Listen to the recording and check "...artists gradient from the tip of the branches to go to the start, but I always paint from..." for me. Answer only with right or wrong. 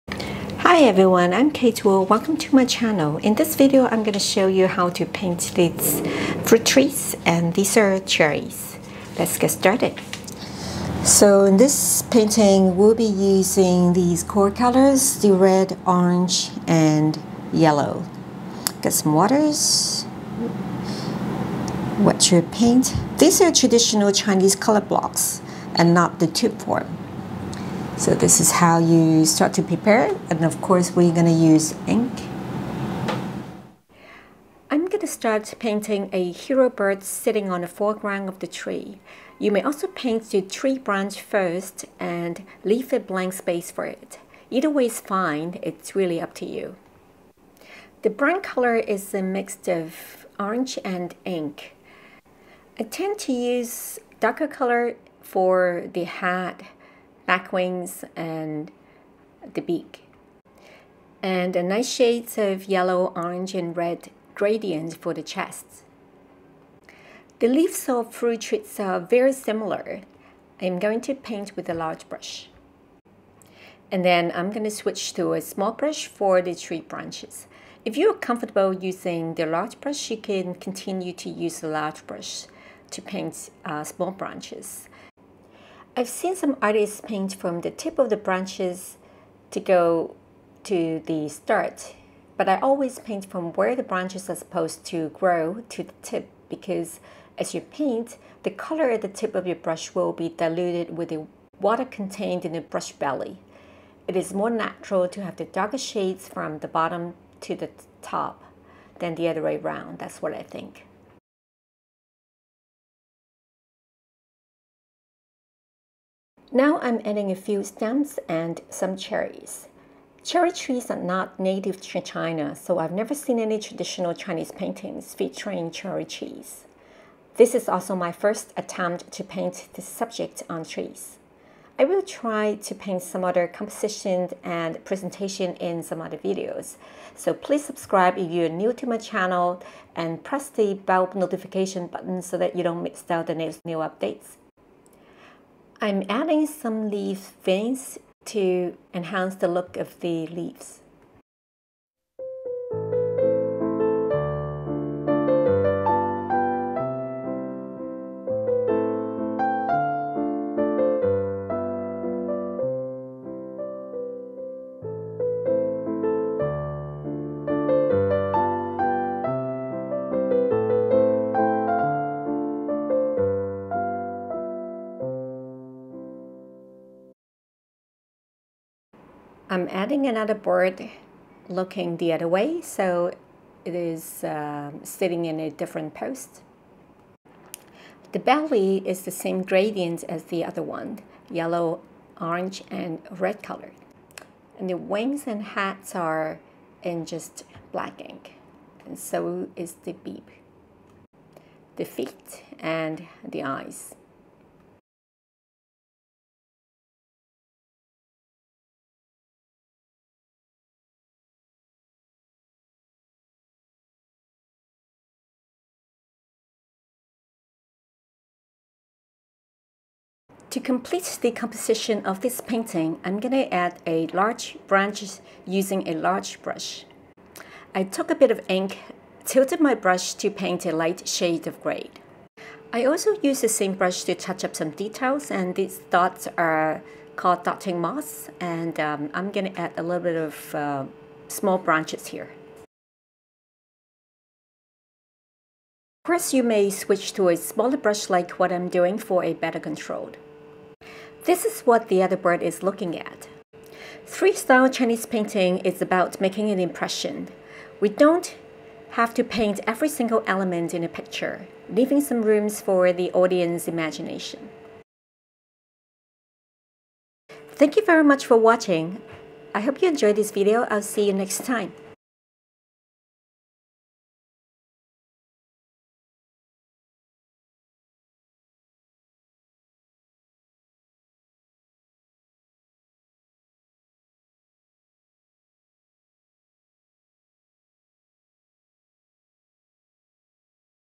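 wrong.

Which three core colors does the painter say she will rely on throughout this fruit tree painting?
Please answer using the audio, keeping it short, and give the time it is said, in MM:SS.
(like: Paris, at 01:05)
Red, orange, and yellow, at 00:15.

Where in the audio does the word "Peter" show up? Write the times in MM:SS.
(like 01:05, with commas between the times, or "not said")
not said.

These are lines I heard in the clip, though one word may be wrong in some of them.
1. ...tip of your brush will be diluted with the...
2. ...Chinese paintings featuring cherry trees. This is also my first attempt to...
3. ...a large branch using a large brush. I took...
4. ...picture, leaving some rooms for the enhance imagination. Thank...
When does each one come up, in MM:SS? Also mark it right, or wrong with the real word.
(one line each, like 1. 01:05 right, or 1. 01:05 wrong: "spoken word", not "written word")
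1. 01:39 right
2. 02:04 right
3. 03:43 right
4. 04:20 wrong: "audience", not "enhance".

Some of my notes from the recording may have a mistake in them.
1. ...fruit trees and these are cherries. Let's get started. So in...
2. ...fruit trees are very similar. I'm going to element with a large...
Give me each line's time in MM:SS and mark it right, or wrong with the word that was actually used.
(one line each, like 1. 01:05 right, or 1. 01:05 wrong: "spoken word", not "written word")
1. 00:06 right
2. 01:08 wrong: "paint", not "element".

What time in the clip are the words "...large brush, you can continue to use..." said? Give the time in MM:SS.
01:19.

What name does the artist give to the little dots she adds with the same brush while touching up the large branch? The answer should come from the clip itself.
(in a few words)
Dotting moss.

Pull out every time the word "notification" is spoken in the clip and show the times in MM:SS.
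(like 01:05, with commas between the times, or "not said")
02:21.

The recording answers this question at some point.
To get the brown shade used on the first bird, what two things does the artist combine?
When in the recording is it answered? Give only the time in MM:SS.
00:50.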